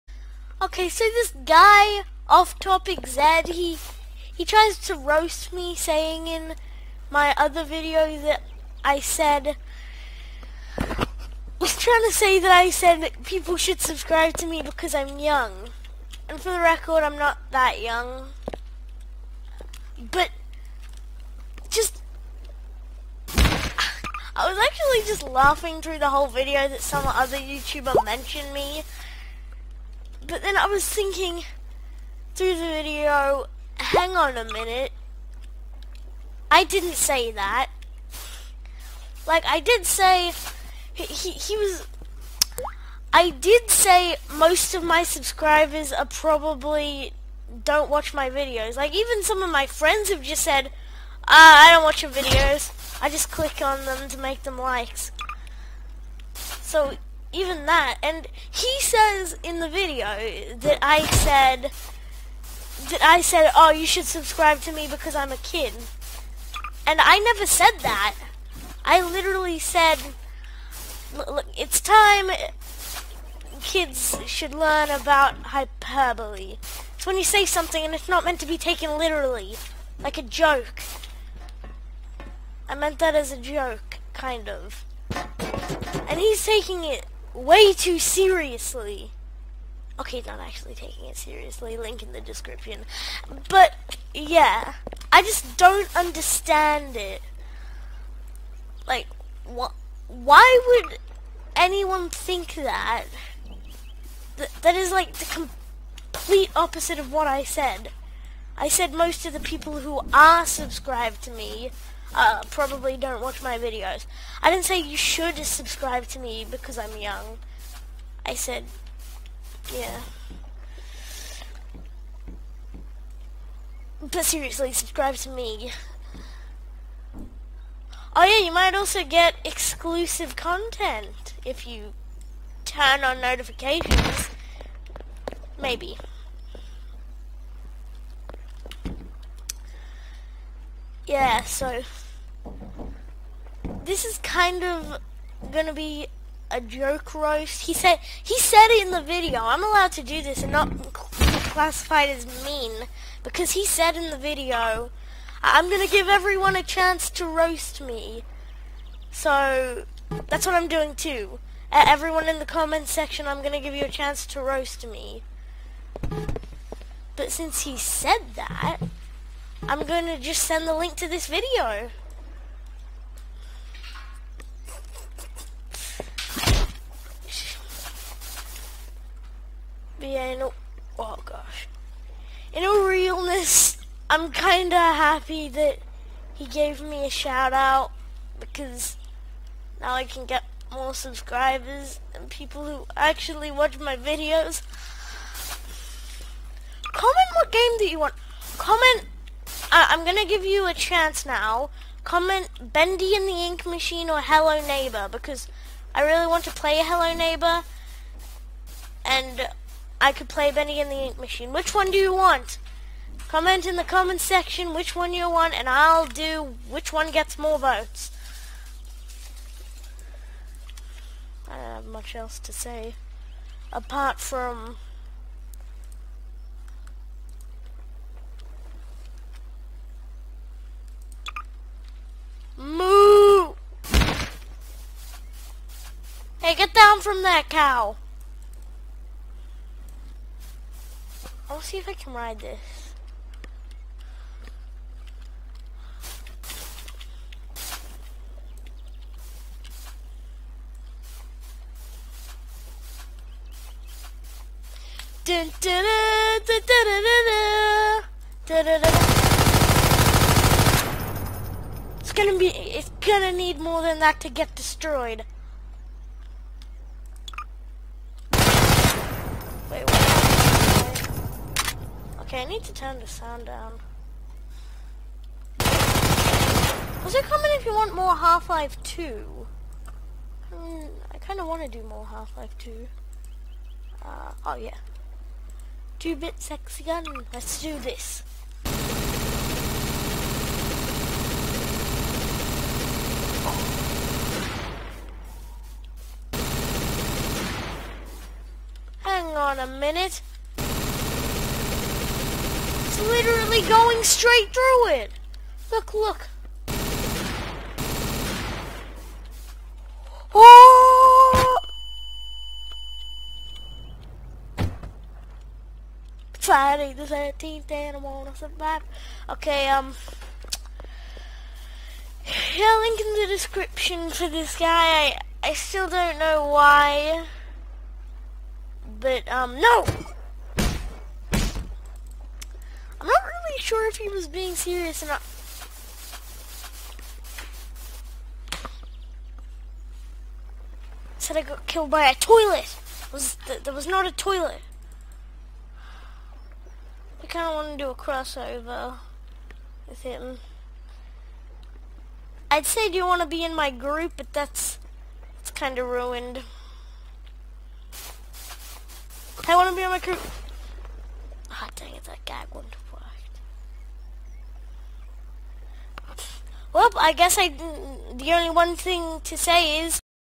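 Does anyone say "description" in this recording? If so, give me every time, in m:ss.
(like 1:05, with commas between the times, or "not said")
1:32, 5:23.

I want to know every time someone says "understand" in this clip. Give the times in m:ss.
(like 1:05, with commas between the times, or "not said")
1:35.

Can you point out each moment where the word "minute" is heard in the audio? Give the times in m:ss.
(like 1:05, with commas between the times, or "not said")
0:34, 4:59.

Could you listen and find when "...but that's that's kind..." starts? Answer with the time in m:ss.
5:54.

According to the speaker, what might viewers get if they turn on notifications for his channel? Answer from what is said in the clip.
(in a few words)
Exclusive content.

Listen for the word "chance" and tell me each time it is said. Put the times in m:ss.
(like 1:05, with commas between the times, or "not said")
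2:36, 2:43, 3:20.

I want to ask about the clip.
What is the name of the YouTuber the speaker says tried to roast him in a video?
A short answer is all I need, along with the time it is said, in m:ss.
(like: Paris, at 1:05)
Off Topic Zed, at 0:02.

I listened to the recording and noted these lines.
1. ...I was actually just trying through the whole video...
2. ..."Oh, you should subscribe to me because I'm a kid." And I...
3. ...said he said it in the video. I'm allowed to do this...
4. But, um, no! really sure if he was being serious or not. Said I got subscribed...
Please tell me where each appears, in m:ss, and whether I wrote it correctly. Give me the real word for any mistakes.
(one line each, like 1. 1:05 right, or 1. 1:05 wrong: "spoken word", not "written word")
1. 0:23 wrong: "laughing", not "trying"
2. 1:03 right
3. 2:27 right
4. 5:28 wrong: "killed", not "subscribed".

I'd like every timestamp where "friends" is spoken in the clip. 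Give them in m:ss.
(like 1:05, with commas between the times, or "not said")
0:49.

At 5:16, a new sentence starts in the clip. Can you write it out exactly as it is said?
Friday the 13th and I want to survive.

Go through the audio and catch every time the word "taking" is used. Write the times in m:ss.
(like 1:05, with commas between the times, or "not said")
1:26, 1:30.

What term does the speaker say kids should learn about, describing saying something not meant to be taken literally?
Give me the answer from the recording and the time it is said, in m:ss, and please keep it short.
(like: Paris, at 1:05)
Hyperbole, at 1:15.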